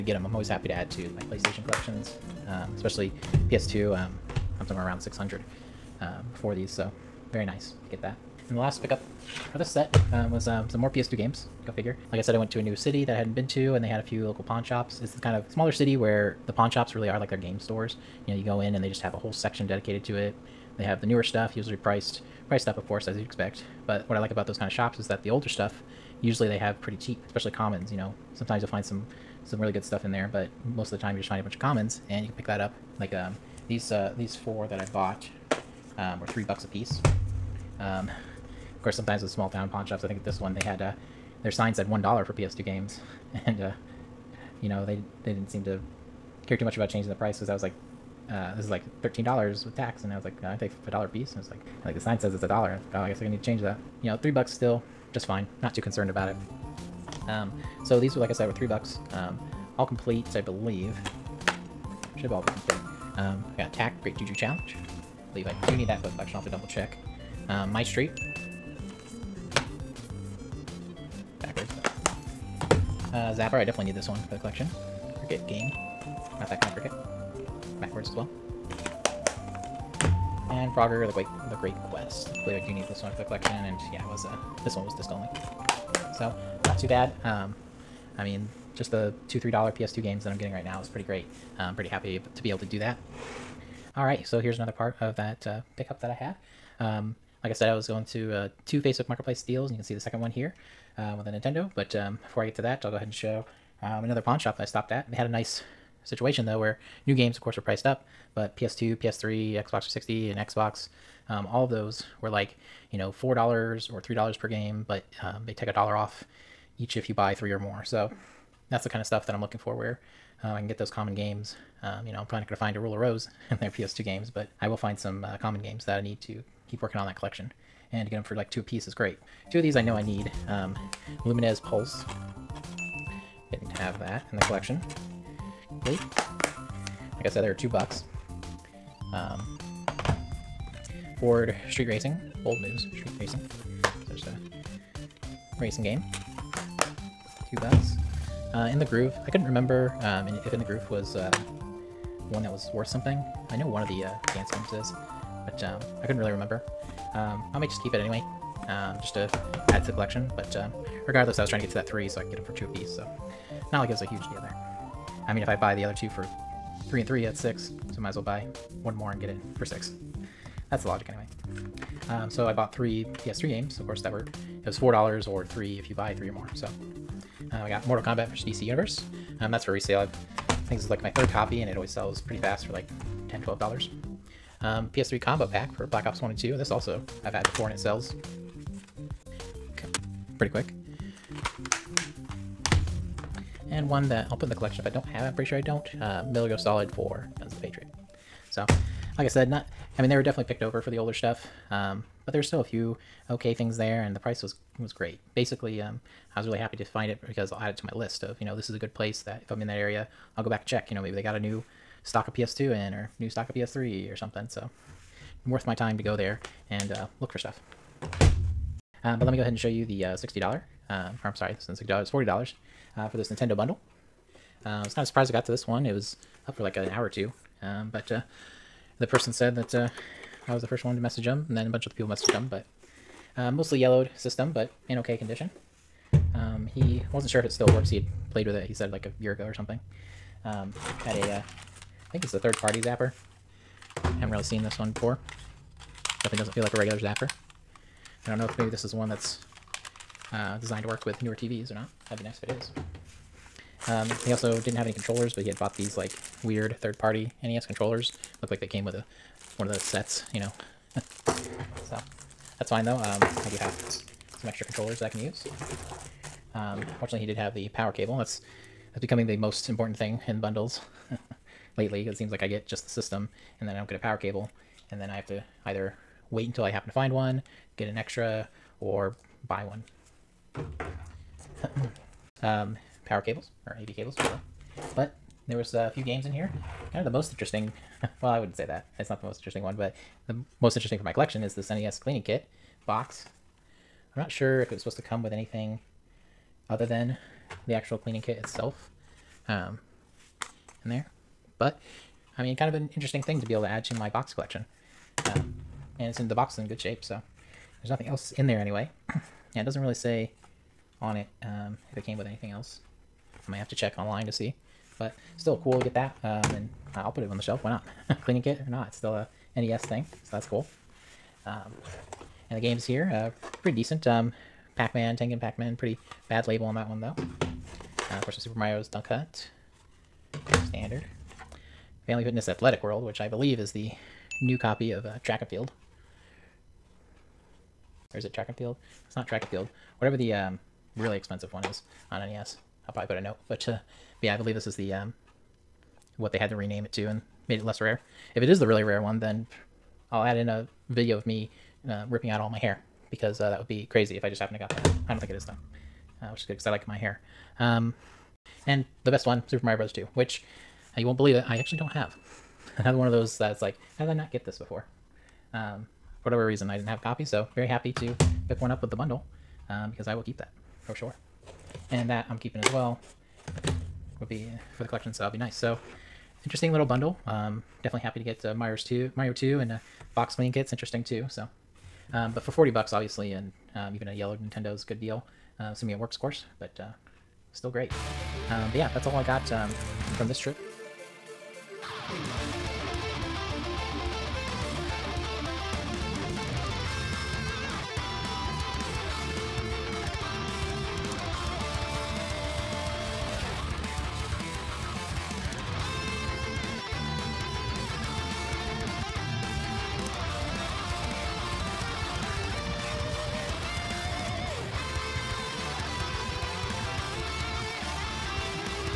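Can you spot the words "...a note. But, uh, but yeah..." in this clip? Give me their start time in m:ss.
5:43.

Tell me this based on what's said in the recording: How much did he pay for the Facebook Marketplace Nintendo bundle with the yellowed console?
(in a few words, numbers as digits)
$40.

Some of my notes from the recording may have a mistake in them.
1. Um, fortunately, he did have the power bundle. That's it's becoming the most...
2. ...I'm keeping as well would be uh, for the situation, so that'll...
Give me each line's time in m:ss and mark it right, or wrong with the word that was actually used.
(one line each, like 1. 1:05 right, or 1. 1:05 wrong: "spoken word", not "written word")
1. 4:26 wrong: "cable", not "bundle"
2. 6:12 wrong: "collection", not "situation".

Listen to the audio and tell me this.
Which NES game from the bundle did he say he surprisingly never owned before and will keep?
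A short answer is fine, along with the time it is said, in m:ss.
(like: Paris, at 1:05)
Super Mario Bros. 2, at 5:59.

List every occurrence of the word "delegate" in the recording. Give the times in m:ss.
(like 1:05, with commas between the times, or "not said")
not said.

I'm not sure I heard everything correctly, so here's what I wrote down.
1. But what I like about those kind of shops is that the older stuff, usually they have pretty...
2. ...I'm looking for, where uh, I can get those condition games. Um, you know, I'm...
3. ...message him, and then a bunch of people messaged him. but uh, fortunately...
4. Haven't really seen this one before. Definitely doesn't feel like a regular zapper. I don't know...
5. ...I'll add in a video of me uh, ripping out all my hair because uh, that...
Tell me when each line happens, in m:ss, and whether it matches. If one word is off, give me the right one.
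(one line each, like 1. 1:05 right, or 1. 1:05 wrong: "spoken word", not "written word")
1. 0:23 right
2. 1:59 wrong: "common", not "condition"
3. 3:50 wrong: "mostly", not "fortunately"
4. 4:04 right
5. 5:50 right.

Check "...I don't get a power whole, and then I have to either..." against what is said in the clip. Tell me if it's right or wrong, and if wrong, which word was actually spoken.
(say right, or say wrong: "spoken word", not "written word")
wrong: "cable", not "whole".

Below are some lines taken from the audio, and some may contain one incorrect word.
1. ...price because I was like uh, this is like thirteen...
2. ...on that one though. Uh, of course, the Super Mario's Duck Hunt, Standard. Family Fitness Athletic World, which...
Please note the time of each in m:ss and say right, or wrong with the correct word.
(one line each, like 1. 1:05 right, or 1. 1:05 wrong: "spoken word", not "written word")
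1. 0:47 right
2. 5:26 right.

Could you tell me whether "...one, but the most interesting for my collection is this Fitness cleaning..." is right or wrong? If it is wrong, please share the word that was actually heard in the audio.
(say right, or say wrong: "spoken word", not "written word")
wrong: "NES", not "Fitness".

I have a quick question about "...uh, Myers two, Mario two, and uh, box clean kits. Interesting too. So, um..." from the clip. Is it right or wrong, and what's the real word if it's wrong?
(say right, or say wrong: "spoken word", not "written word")
right.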